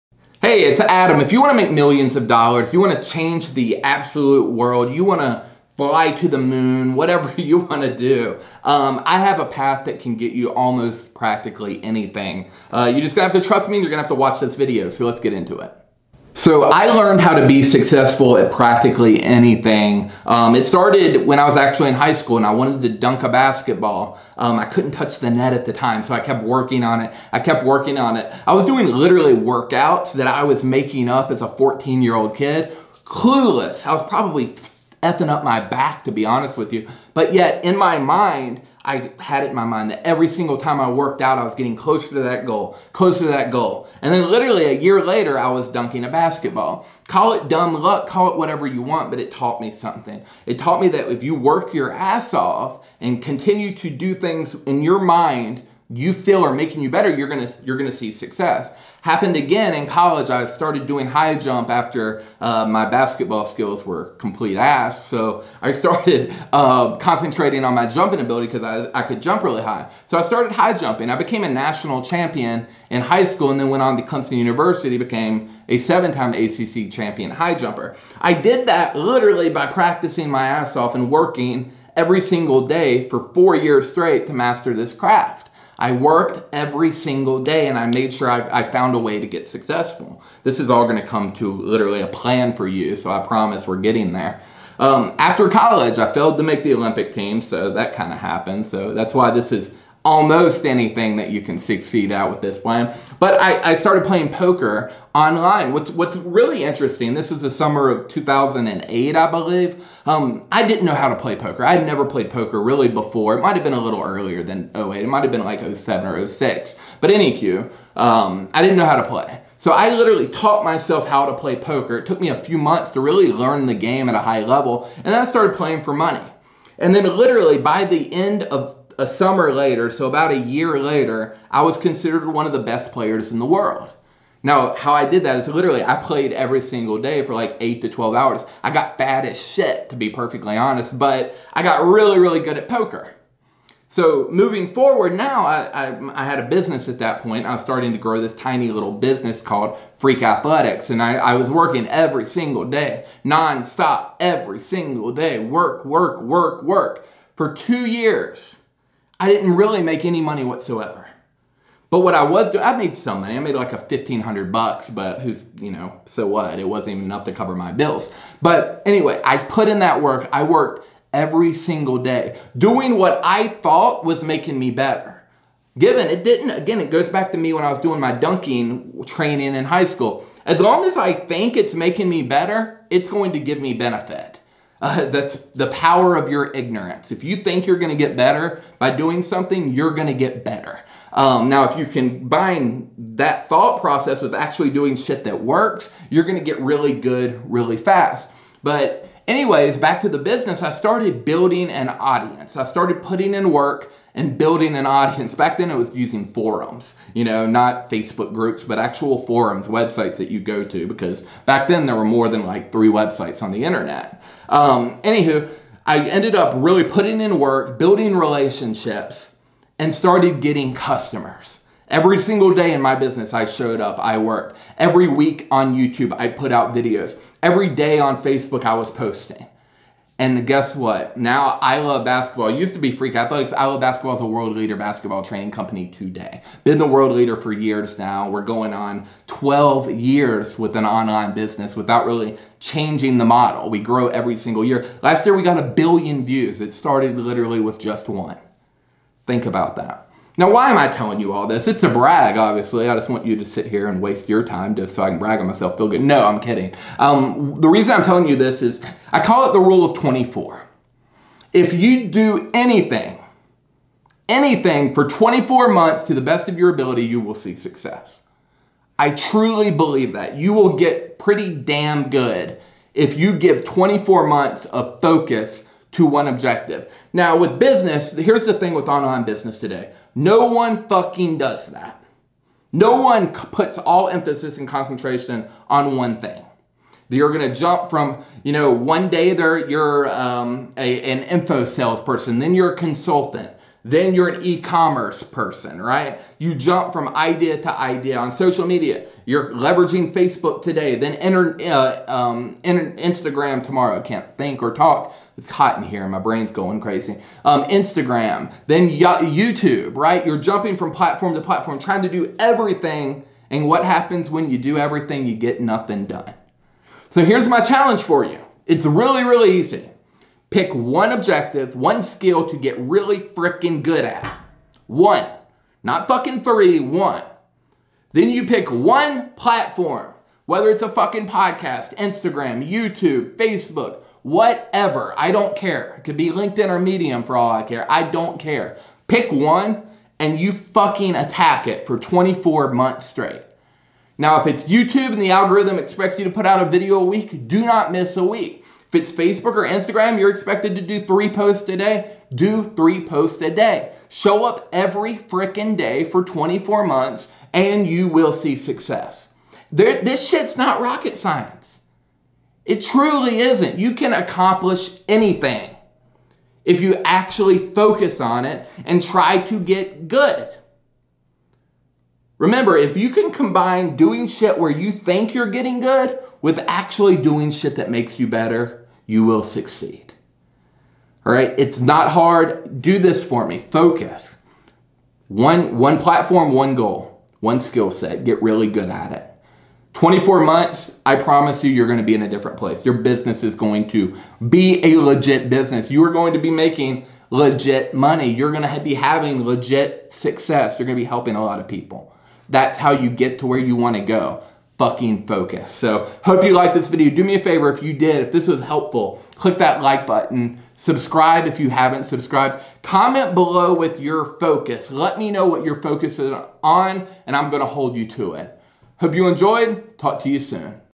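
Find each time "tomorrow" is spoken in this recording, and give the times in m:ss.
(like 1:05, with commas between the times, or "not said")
5:03.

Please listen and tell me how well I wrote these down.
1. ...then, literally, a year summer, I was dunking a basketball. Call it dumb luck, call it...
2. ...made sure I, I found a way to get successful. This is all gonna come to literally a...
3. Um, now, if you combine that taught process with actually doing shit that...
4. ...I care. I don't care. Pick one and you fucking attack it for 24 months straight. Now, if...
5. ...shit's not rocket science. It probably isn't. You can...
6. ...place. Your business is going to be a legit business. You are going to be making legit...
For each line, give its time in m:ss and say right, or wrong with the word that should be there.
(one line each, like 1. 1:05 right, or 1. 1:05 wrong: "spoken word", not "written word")
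1. 0:44 wrong: "later", not "summer"
2. 1:27 right
3. 3:11 wrong: "thought", not "taught"
4. 5:37 right
5. 6:00 wrong: "truly", not "probably"
6. 6:32 right.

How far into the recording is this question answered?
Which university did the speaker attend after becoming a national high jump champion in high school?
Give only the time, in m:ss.
1:14.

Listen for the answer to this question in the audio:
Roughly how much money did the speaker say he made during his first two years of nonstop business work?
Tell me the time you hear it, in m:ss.
2:43.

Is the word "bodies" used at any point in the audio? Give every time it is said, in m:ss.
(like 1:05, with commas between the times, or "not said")
not said.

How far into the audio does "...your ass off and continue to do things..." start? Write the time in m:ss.
0:51.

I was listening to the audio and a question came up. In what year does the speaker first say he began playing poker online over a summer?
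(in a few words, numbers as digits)
2008.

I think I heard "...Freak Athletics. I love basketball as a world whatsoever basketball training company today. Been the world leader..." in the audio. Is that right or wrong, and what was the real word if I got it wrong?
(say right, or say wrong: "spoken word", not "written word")
wrong: "leader", not "whatsoever".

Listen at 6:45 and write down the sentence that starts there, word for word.
So hope you liked this video.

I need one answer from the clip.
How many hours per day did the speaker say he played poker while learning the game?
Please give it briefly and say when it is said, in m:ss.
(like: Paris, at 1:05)
8 to 12, at 2:17.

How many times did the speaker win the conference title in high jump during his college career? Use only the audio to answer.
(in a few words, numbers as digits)
7.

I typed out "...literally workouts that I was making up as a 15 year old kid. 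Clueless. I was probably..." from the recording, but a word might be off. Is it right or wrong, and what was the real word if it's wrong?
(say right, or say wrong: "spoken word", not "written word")
wrong: "14", not "15".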